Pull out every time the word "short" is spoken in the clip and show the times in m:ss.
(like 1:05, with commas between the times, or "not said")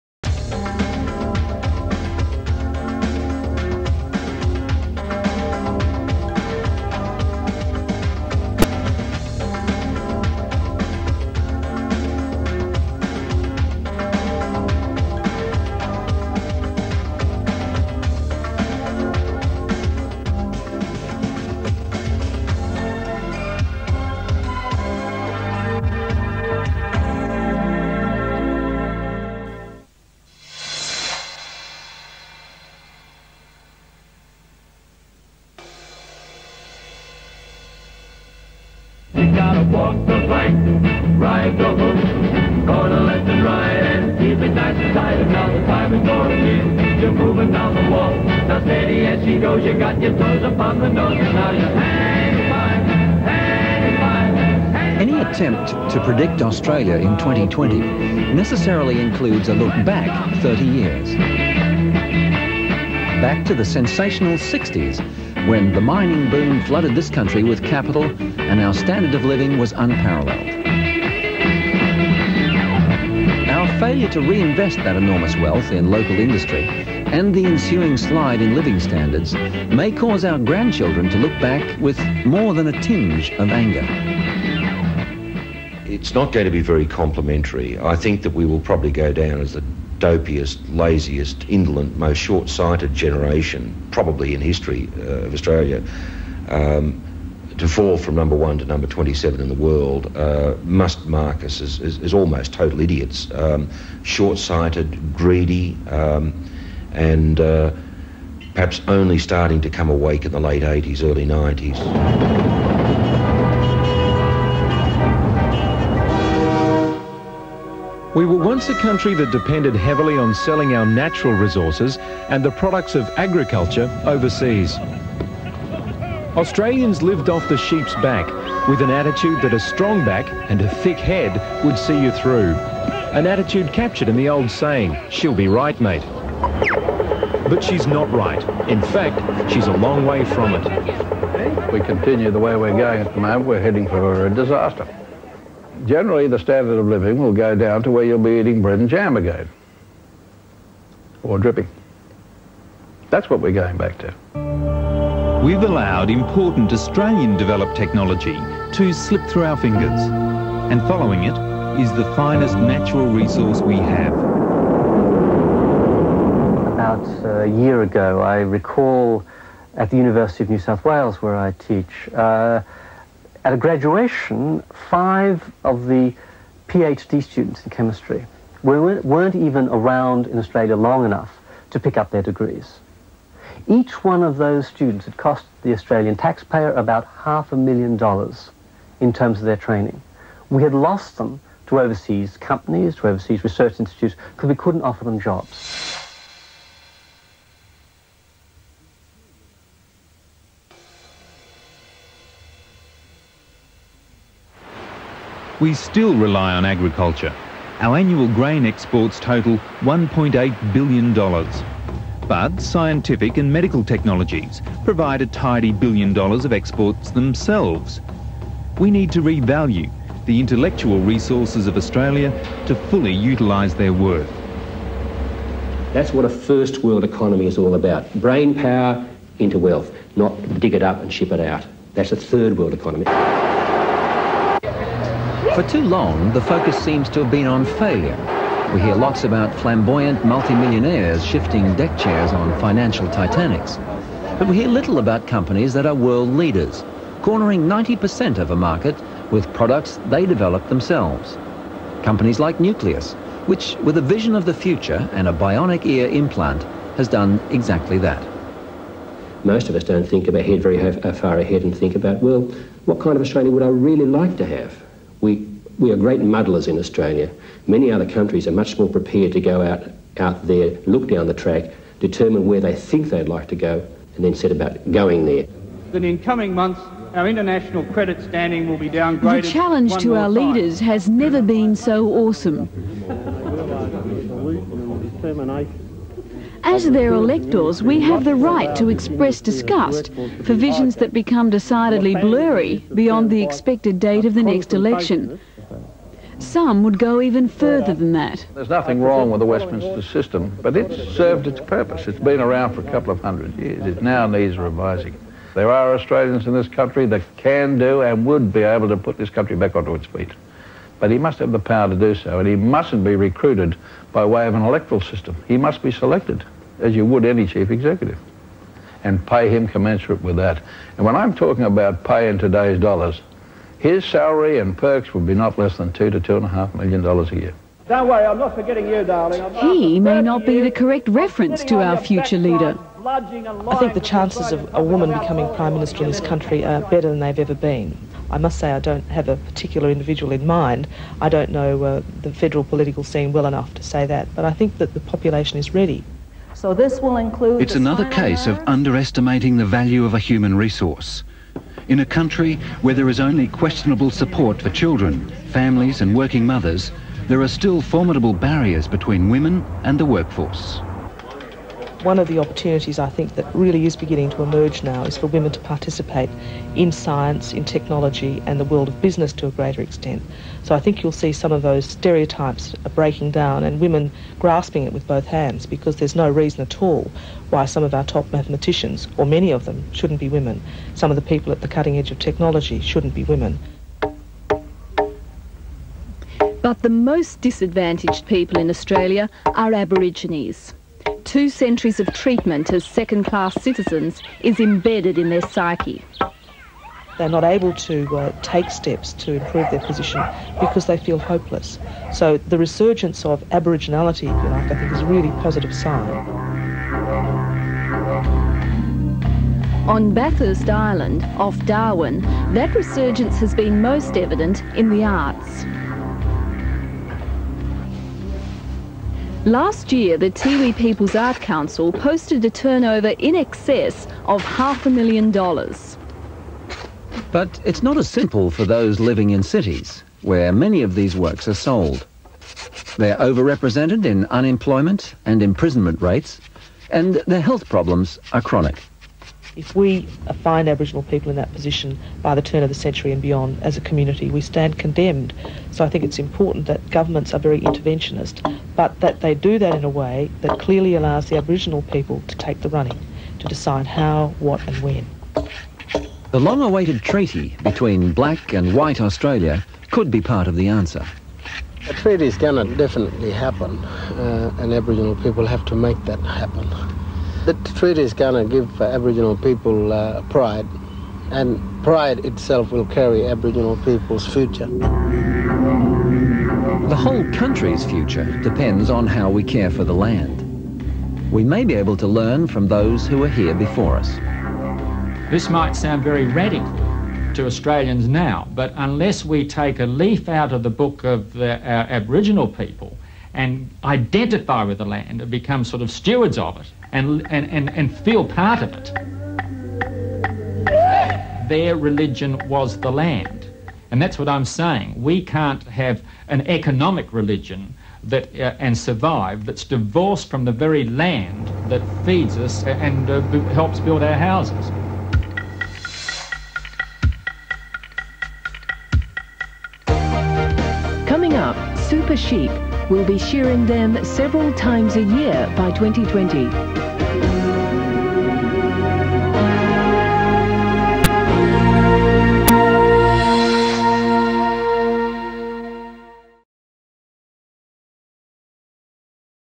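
1:32, 1:44.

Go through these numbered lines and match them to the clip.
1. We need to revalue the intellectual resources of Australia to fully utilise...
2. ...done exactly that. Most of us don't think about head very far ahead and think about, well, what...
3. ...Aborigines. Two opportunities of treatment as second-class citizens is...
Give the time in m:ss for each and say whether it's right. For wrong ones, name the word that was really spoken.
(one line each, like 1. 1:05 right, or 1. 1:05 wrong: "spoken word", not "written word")
1. 3:38 right
2. 4:17 right
3. 6:29 wrong: "centuries", not "opportunities".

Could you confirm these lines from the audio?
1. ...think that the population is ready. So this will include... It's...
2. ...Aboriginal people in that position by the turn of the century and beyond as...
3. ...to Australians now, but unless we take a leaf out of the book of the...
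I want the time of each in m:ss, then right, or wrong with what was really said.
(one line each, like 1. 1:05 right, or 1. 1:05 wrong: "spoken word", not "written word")
1. 5:44 right
2. 7:20 right
3. 8:07 right.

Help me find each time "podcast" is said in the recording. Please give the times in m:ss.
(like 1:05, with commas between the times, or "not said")
not said.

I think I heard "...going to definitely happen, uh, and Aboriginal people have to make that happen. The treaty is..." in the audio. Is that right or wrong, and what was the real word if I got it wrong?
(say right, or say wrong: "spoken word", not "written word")
right.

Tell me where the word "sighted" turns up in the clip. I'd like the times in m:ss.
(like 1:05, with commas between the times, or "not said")
1:32, 1:44.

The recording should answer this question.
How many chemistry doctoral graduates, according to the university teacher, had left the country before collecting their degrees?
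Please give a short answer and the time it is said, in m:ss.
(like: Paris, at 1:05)
5, at 2:54.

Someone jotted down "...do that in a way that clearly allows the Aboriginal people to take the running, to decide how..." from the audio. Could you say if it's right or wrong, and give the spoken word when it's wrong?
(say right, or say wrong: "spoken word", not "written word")
right.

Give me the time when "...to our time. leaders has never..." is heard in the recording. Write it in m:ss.
4:39.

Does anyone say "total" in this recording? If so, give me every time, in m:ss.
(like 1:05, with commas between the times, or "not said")
1:42, 3:29.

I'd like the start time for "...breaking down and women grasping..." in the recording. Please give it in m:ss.
6:12.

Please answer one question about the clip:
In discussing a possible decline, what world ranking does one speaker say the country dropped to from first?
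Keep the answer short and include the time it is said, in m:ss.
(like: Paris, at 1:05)
27, at 1:38.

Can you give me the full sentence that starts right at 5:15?
He must be selected, as you would any chief executive, and pay him commensurate with that.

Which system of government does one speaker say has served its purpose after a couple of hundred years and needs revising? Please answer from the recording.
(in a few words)
Westminster system.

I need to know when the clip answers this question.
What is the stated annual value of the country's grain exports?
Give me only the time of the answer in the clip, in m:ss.
3:29.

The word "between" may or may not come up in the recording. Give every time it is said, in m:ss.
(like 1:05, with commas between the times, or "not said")
5:58, 7:37.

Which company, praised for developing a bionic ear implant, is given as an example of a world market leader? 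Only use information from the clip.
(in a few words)
Nucleus.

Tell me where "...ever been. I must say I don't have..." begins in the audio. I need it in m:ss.
5:37.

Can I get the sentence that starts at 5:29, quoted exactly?
he may not be the correct reference to our future leader.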